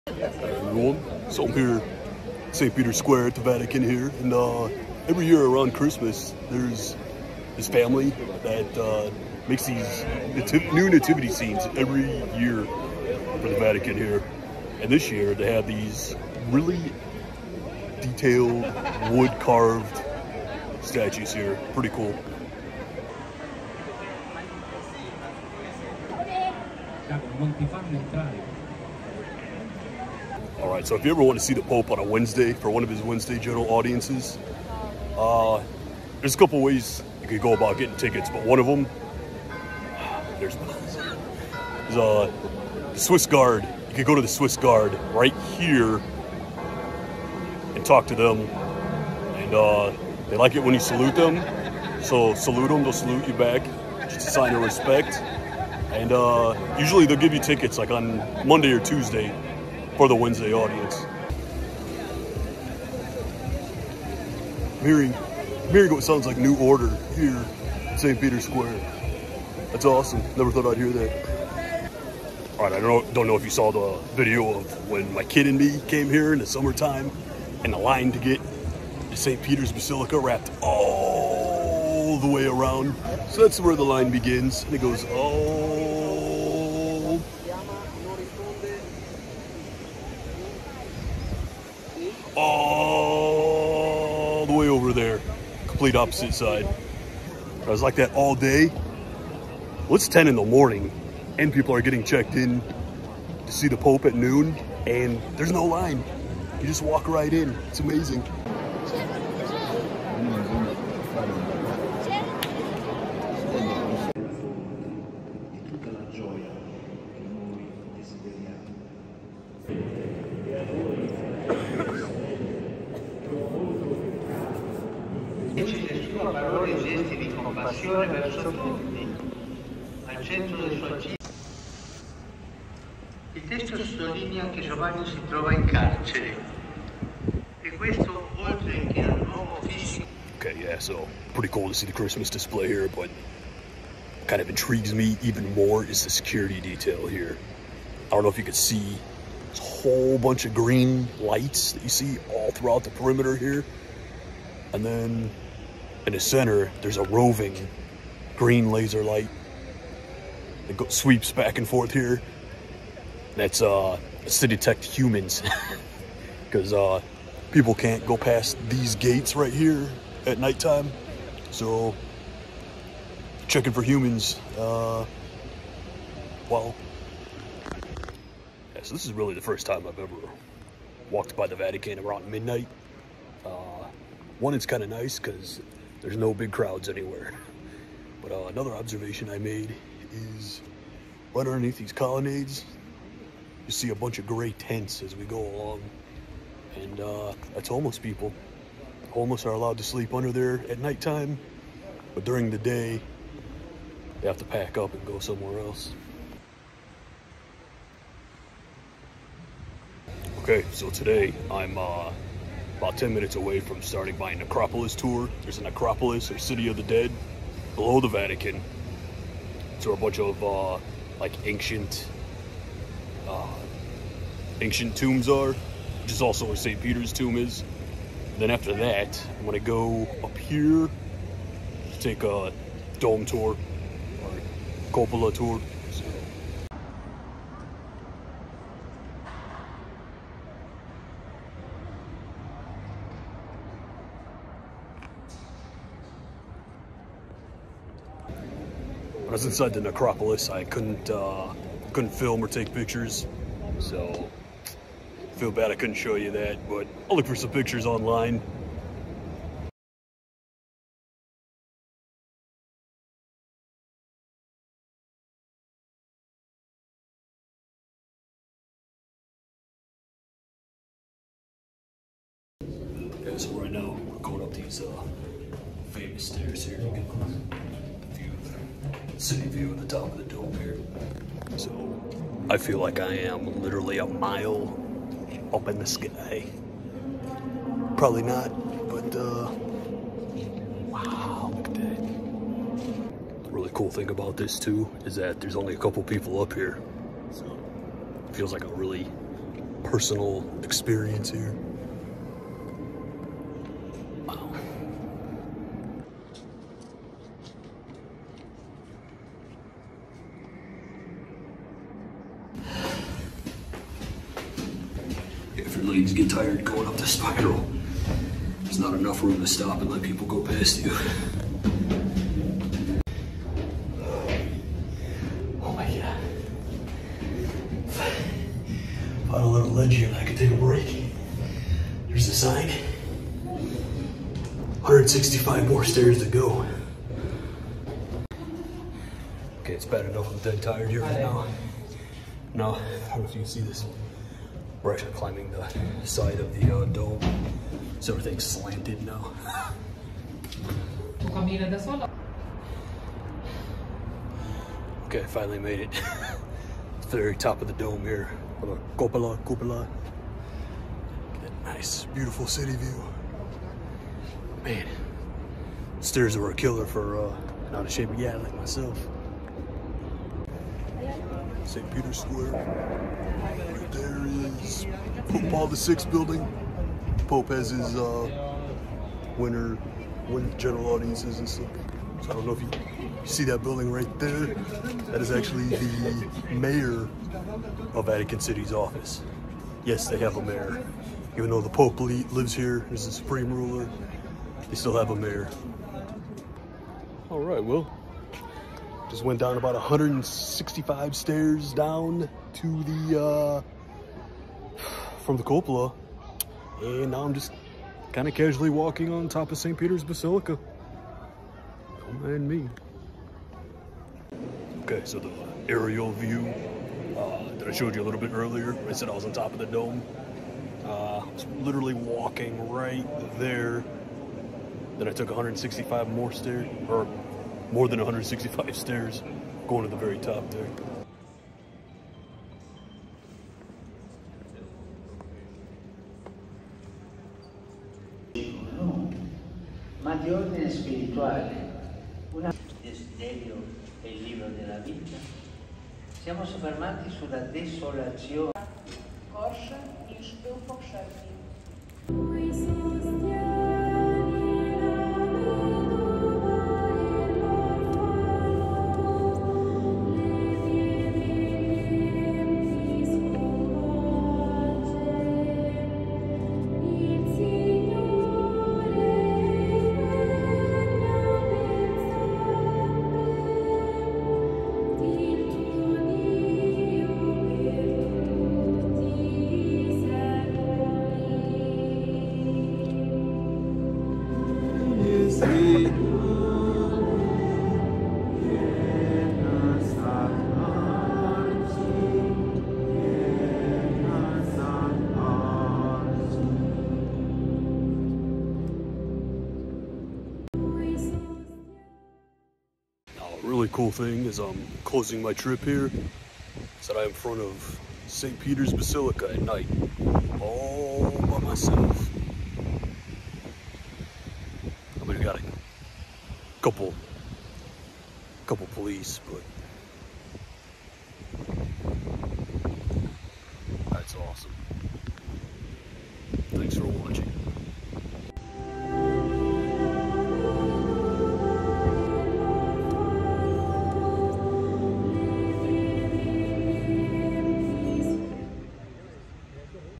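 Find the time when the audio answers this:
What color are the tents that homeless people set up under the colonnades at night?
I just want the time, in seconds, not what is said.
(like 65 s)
194 s.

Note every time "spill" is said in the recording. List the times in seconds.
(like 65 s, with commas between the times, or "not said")
not said.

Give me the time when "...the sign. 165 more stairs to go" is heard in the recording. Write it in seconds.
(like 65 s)
332 s.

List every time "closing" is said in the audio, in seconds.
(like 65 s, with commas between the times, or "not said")
504 s.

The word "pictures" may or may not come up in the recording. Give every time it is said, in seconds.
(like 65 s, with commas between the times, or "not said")
252 s, 257 s.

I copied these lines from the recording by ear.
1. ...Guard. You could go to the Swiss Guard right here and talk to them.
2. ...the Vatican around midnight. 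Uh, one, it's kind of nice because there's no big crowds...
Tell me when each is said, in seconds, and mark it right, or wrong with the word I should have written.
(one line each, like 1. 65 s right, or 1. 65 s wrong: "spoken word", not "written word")
1. 43 s right
2. 181 s right.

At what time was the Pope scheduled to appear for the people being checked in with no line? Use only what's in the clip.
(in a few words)
Noon.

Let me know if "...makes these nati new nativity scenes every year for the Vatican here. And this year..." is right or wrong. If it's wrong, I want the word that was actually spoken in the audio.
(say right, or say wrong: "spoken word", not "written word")
right.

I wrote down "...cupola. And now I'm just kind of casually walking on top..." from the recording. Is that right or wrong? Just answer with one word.
right.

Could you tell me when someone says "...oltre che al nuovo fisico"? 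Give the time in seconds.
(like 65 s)
138 s.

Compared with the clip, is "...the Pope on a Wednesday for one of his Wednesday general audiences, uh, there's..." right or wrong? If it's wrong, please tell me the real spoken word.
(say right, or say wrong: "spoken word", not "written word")
right.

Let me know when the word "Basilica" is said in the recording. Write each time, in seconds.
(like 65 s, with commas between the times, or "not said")
79 s, 410 s, 508 s.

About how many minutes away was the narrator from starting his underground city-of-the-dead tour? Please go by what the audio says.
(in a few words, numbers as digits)
10.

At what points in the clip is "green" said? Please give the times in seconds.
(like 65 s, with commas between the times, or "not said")
150 s, 158 s.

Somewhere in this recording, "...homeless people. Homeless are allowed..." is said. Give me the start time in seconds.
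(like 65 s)
197 s.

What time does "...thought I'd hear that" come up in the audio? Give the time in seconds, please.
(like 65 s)
70 s.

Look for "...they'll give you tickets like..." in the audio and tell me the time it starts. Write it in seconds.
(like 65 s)
57 s.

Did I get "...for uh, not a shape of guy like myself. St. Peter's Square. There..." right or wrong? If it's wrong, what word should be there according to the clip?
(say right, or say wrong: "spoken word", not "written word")
right.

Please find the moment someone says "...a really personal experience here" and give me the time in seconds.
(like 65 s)
298 s.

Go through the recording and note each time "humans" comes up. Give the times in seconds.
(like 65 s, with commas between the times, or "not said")
164 s, 173 s.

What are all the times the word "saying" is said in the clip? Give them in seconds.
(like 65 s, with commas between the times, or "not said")
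not said.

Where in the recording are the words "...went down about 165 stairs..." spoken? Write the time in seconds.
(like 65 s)
399 s.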